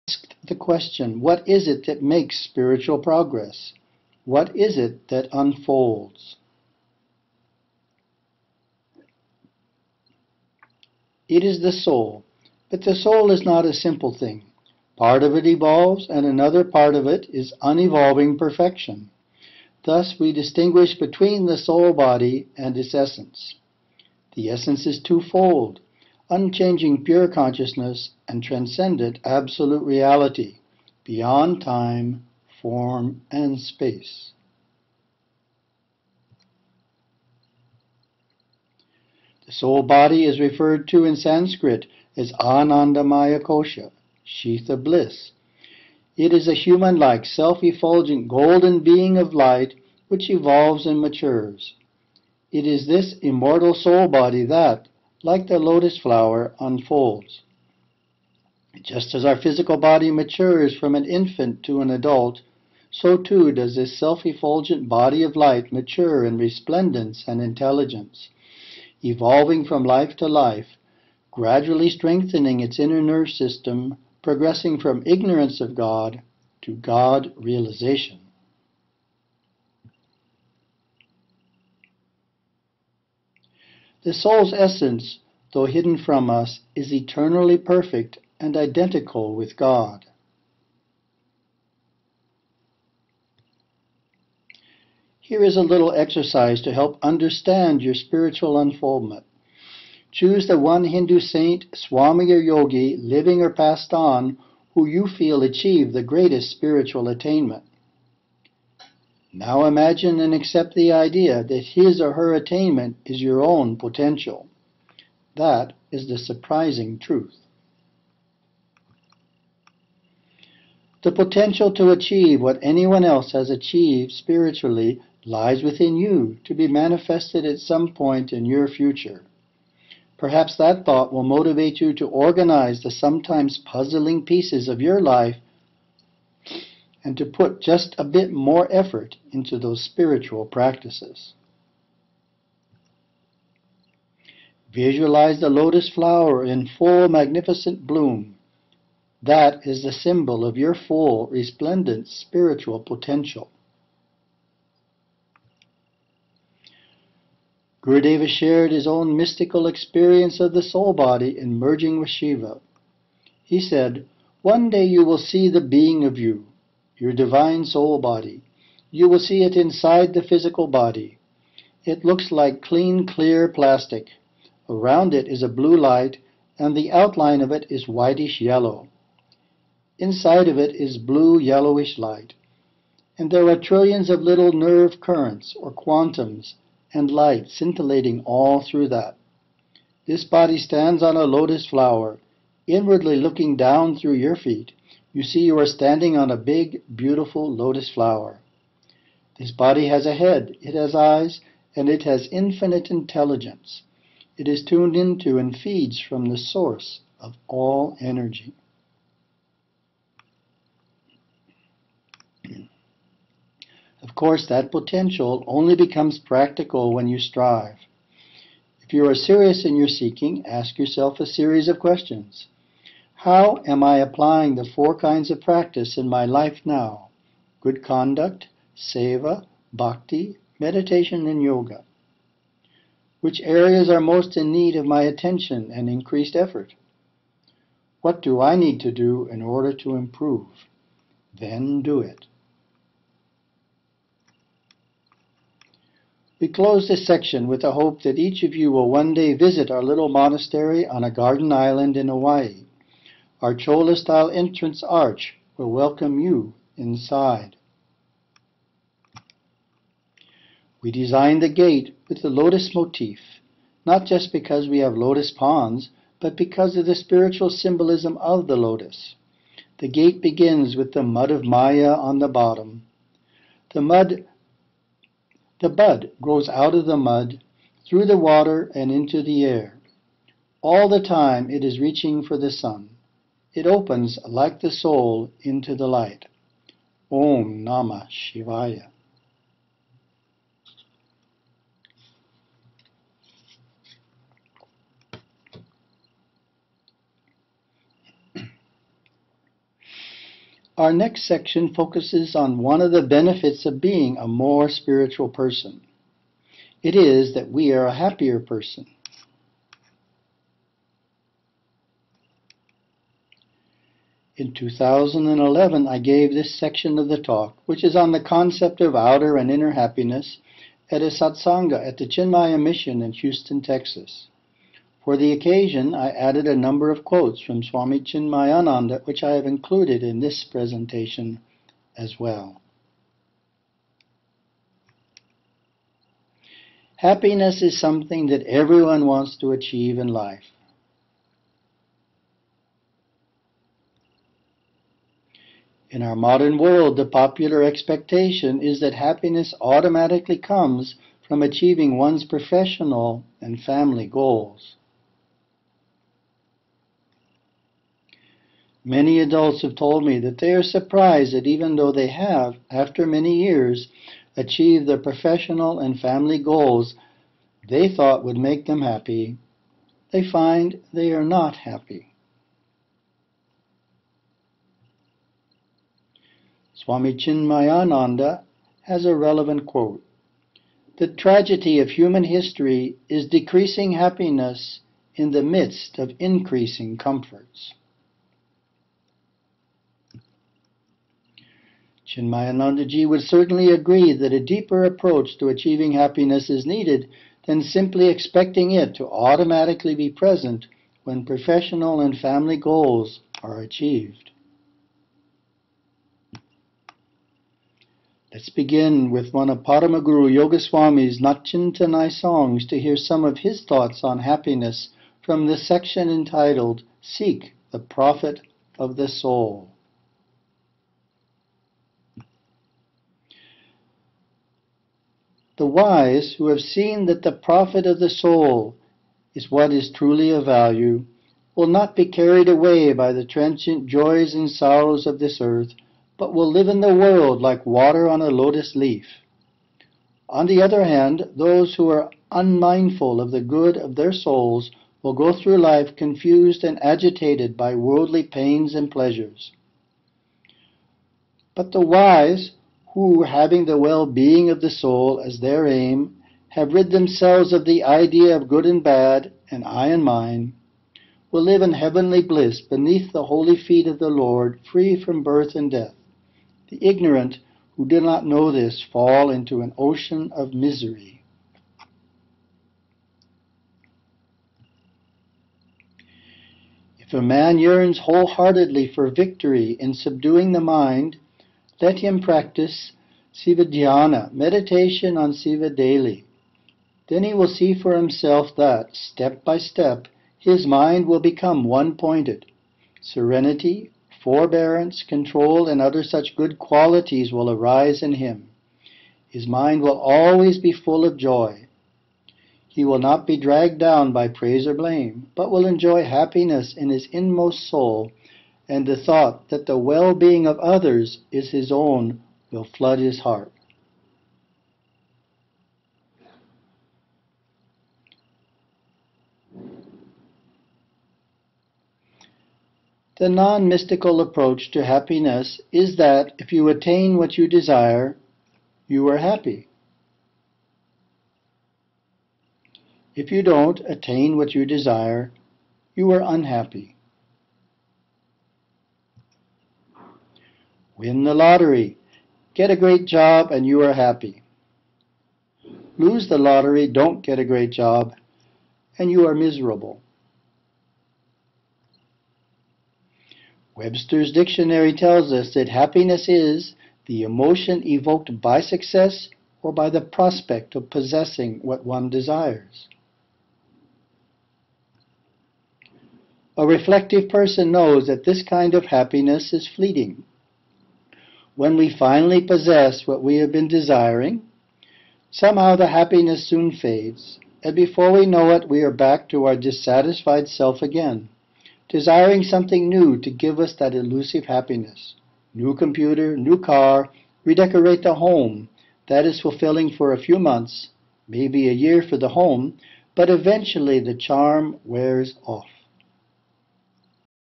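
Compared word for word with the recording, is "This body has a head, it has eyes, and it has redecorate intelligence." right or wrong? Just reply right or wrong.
wrong.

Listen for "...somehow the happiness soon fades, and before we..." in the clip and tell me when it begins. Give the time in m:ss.
9:35.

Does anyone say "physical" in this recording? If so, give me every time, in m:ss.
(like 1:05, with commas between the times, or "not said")
0:59, 2:50.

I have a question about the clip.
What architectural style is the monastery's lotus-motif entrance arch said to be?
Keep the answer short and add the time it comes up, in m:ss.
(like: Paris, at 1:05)
Chola-style, at 4:13.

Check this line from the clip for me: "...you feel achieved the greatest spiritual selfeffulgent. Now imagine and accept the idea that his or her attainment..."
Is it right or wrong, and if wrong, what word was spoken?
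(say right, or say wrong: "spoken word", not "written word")
wrong: "attainment", not "selfeffulgent".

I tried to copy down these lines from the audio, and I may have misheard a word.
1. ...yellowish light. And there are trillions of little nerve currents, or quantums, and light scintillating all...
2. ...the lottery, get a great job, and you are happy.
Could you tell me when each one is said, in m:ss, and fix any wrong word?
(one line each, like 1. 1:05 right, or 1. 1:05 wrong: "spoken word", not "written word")
1. 3:01 right
2. 9:01 right.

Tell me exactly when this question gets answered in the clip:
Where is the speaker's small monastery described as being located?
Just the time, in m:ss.
4:11.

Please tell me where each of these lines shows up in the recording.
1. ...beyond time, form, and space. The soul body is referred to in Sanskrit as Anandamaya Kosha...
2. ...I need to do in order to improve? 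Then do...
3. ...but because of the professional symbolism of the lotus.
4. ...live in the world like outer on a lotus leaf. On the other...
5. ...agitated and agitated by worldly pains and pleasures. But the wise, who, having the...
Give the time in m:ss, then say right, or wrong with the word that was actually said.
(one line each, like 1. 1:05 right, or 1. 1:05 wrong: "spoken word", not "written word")
1. 0:31 right
2. 3:58 right
3. 4:26 wrong: "spiritual", not "professional"
4. 7:16 wrong: "water", not "outer"
5. 7:25 wrong: "confused", not "agitated".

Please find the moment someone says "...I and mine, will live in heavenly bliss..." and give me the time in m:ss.
7:39.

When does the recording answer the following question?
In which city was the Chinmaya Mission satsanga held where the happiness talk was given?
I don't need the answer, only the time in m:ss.
5:23.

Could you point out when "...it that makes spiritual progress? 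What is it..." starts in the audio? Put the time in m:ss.
0:01.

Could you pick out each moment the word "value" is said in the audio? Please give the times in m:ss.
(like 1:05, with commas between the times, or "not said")
7:10.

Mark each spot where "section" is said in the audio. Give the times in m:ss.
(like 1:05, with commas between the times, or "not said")
4:07, 5:01, 5:16, 6:55.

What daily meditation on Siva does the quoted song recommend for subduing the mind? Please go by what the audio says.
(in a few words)
Sivadhyana.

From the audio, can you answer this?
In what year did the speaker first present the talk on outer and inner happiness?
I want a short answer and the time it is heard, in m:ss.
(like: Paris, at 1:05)
2011, at 5:14.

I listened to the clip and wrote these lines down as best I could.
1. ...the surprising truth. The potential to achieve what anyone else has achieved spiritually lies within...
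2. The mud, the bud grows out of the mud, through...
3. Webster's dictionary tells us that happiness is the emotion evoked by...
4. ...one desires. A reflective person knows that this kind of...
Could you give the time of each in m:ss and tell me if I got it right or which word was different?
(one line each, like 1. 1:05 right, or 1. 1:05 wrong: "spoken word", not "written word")
1. 1:56 right
2. 4:33 right
3. 9:13 right
4. 9:21 right.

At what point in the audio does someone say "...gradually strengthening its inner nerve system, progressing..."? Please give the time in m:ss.
1:11.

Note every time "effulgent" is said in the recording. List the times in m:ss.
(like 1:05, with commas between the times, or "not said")
0:47, 1:03.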